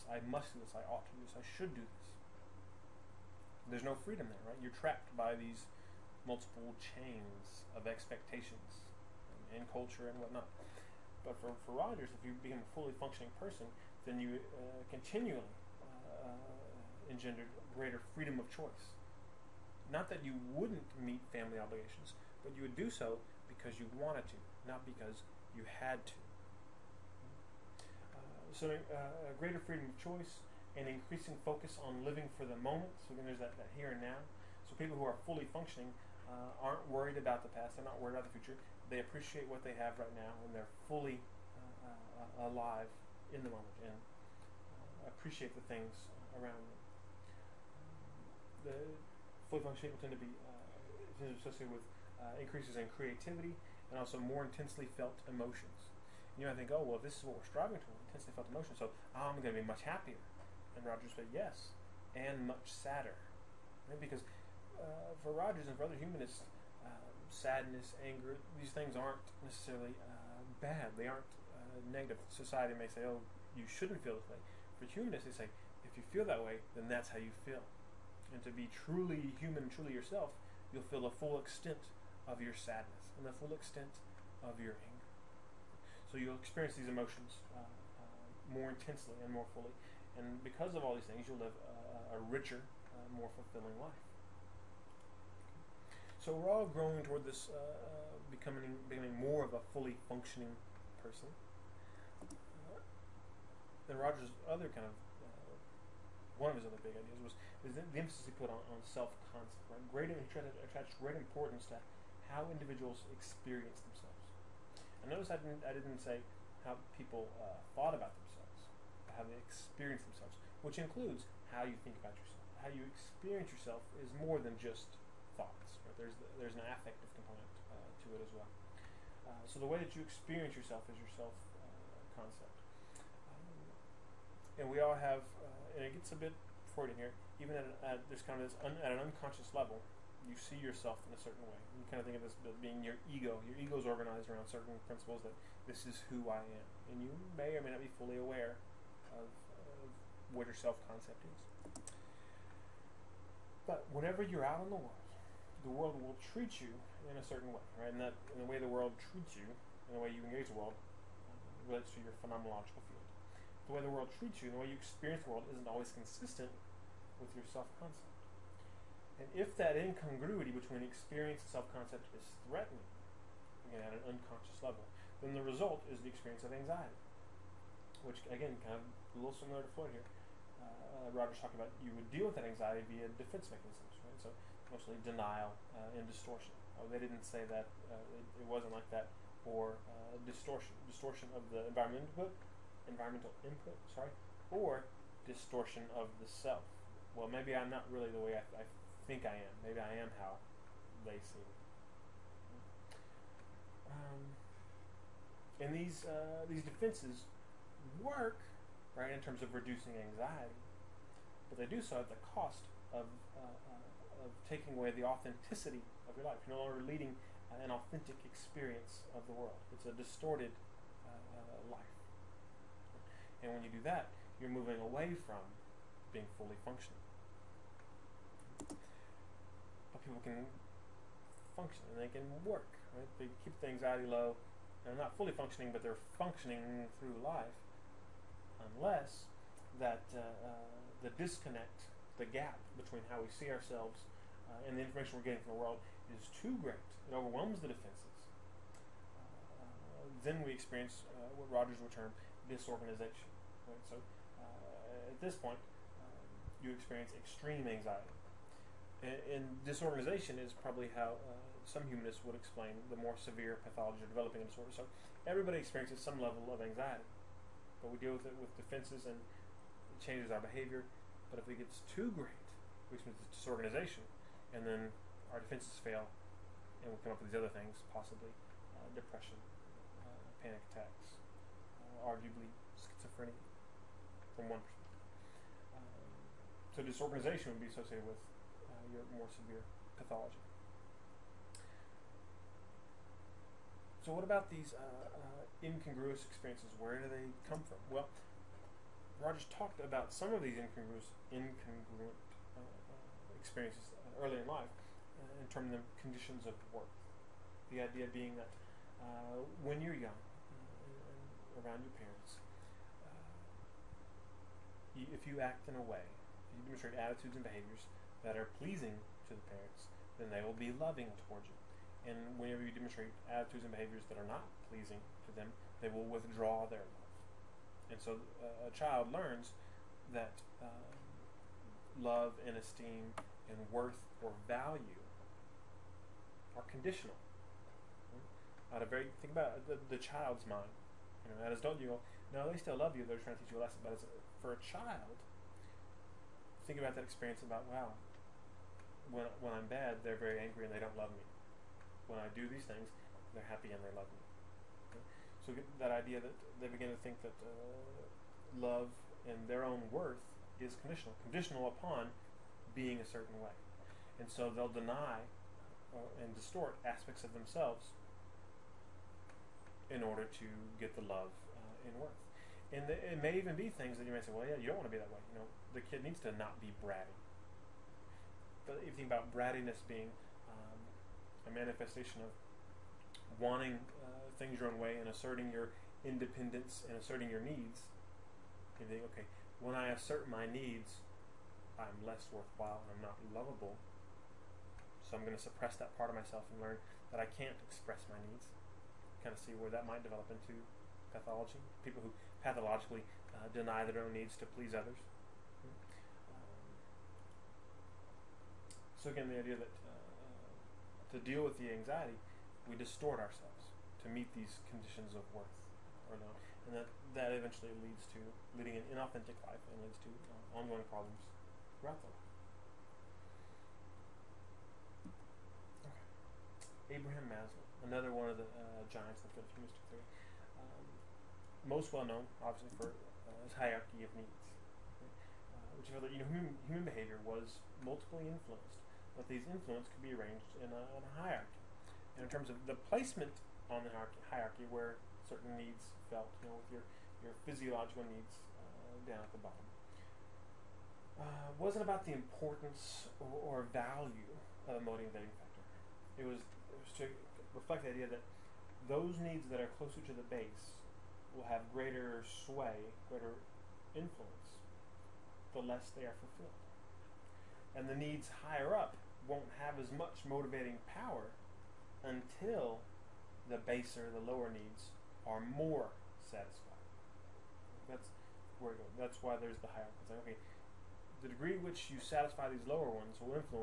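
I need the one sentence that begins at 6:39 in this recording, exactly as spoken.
Kind of see where that might develop into pathology, people who pathologically uh, deny their own needs to please others.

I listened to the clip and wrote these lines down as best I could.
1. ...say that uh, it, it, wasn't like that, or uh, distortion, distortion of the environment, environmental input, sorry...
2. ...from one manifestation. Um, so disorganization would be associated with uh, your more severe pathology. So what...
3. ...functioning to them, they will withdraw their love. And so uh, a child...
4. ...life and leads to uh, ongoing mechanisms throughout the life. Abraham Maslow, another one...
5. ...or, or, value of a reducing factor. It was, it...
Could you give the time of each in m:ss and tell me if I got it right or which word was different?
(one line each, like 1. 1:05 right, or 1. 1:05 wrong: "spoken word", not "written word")
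1. 3:07 right
2. 4:44 wrong: "person", not "manifestation"
3. 5:24 wrong: "pleasing", not "functioning"
4. 6:59 wrong: "problems", not "mechanisms"
5. 7:33 wrong: "motivating", not "reducing".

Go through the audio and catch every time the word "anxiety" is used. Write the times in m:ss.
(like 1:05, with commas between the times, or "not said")
2:56, 3:02, 3:29, 3:53, 4:17, 4:26, 6:51.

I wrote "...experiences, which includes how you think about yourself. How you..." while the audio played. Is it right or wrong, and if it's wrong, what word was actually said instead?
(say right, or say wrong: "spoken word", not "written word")
wrong: "themselves", not "experiences".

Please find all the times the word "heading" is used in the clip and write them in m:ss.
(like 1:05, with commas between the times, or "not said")
not said.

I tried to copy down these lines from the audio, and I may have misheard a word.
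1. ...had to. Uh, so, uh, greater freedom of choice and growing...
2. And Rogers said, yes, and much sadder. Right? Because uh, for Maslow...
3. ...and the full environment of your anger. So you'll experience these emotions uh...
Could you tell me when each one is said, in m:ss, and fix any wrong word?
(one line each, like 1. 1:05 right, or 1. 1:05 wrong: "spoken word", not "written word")
1. 0:25 wrong: "increasing", not "growing"
2. 1:00 wrong: "Rogers", not "Maslow"
3. 1:23 wrong: "extent", not "environment".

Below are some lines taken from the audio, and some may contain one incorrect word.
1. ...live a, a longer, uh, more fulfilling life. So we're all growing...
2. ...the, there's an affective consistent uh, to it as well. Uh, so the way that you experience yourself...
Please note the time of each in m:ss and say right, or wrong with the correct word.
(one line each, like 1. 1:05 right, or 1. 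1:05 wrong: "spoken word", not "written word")
1. 1:31 wrong: "richer", not "longer"
2. 2:06 wrong: "component", not "consistent".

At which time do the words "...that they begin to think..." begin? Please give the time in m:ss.
5:56.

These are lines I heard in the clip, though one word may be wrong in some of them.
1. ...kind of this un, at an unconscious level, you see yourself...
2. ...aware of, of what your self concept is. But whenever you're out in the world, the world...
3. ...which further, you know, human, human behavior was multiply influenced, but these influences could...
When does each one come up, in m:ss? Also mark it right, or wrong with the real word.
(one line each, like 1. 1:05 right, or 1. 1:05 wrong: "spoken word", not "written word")
1. 2:18 right
2. 2:28 right
3. 7:15 right.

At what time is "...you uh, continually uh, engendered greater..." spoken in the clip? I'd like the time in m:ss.
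0:14.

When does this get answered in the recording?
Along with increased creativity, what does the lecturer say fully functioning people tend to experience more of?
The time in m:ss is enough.
0:54.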